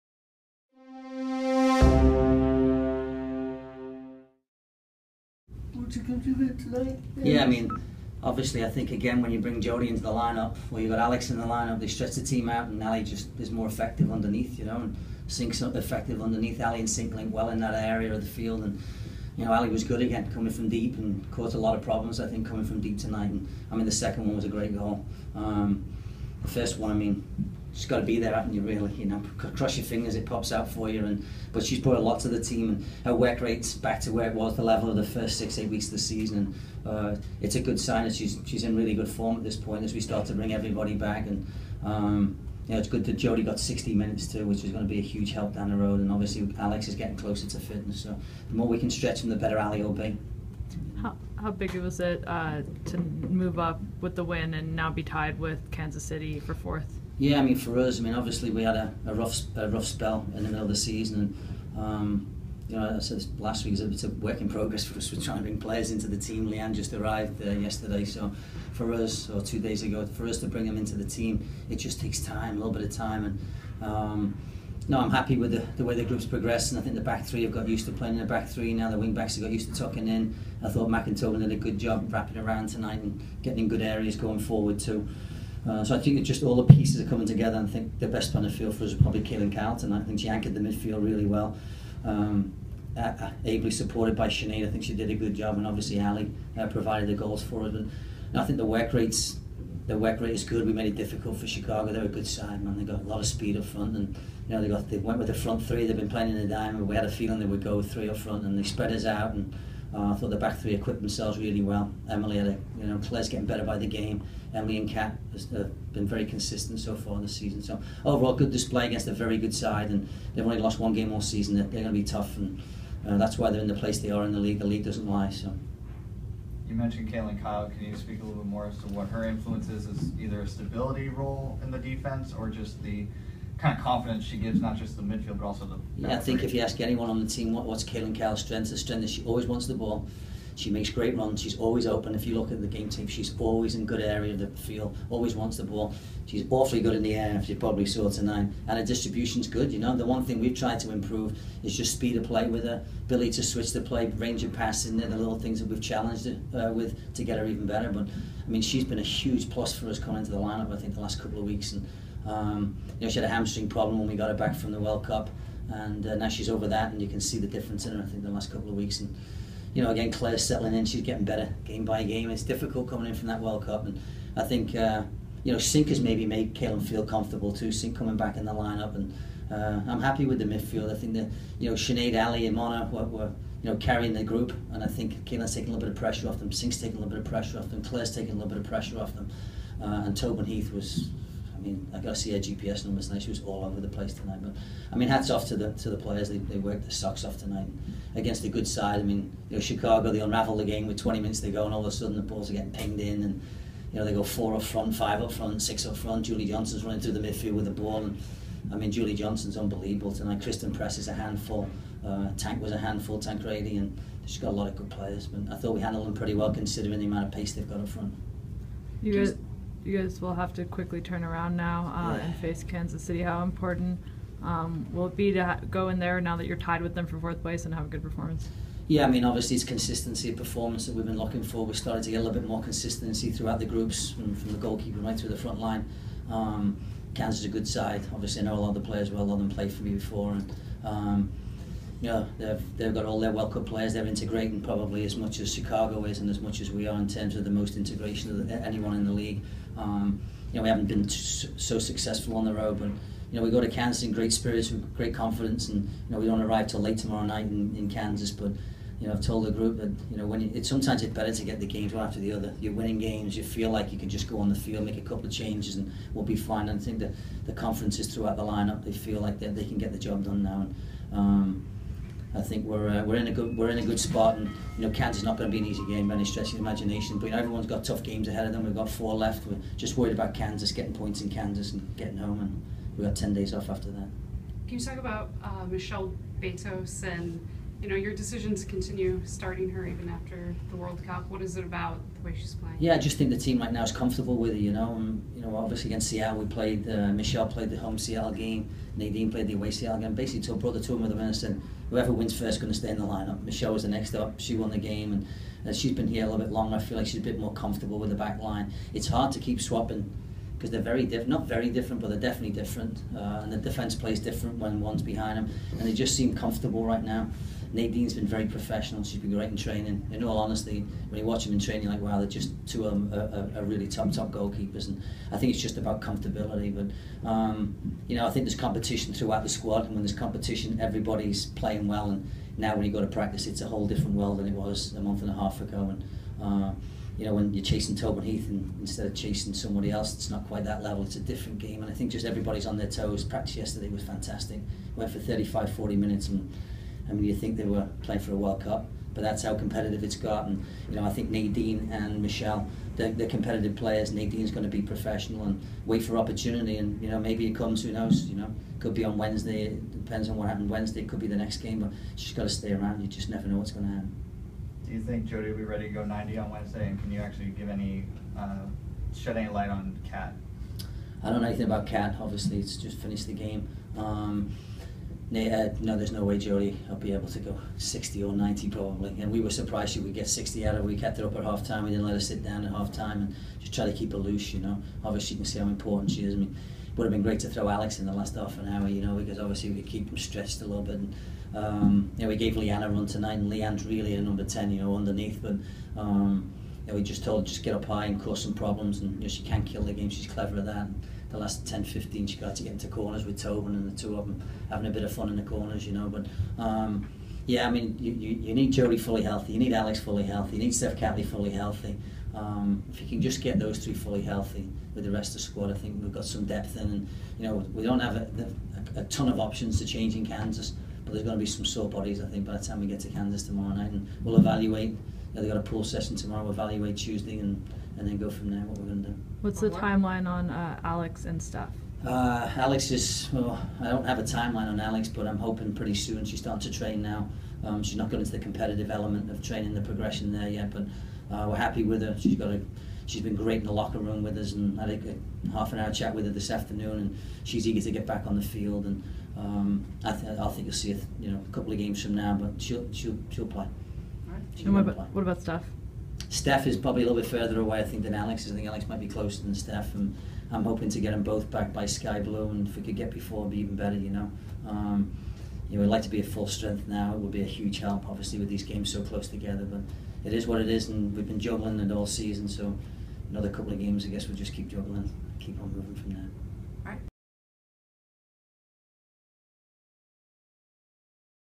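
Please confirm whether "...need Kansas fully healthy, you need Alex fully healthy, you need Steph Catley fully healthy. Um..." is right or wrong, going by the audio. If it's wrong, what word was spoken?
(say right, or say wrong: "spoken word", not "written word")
wrong: "Jodie", not "Kansas".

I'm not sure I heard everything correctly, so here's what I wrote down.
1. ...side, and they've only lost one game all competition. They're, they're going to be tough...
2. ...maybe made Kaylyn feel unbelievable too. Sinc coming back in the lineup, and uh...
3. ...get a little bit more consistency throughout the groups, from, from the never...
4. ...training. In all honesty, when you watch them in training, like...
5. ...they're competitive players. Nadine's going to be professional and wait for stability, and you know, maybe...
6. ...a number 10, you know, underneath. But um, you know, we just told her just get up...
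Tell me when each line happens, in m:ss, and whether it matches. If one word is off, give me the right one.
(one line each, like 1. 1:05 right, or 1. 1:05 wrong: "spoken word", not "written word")
1. 1:59 wrong: "season", not "competition"
2. 2:55 wrong: "comfortable", not "unbelievable"
3. 3:52 wrong: "goalkeeper", not "never"
4. 5:19 right
5. 5:53 wrong: "opportunity", not "stability"
6. 6:34 right.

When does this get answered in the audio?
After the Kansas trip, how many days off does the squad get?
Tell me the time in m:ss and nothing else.
4:43.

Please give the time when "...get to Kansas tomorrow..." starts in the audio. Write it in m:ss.
7:02.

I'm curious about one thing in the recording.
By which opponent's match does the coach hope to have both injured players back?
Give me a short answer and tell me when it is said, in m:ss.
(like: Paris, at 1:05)
Sky Blue, at 7:41.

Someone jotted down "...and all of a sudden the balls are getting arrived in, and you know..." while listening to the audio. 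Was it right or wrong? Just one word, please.
wrong.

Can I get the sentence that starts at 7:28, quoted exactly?
And um, I, th- I think you'll see it, you know, a couple of games from now, but she'll she'll she'll play.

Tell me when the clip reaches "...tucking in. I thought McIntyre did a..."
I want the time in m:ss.
1:19.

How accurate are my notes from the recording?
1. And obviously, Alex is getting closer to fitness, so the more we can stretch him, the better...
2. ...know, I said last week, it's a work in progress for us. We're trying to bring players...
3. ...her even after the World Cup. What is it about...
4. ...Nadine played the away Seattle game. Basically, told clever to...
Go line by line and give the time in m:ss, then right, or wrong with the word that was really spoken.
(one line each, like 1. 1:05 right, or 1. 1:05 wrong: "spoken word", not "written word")
1. 0:45 right
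2. 1:02 right
3. 4:49 right
4. 4:58 wrong: "brother", not "clever".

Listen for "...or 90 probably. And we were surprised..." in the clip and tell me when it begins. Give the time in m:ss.
6:18.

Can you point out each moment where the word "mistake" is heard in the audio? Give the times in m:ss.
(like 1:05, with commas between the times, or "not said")
not said.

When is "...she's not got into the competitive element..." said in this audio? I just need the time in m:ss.
7:17.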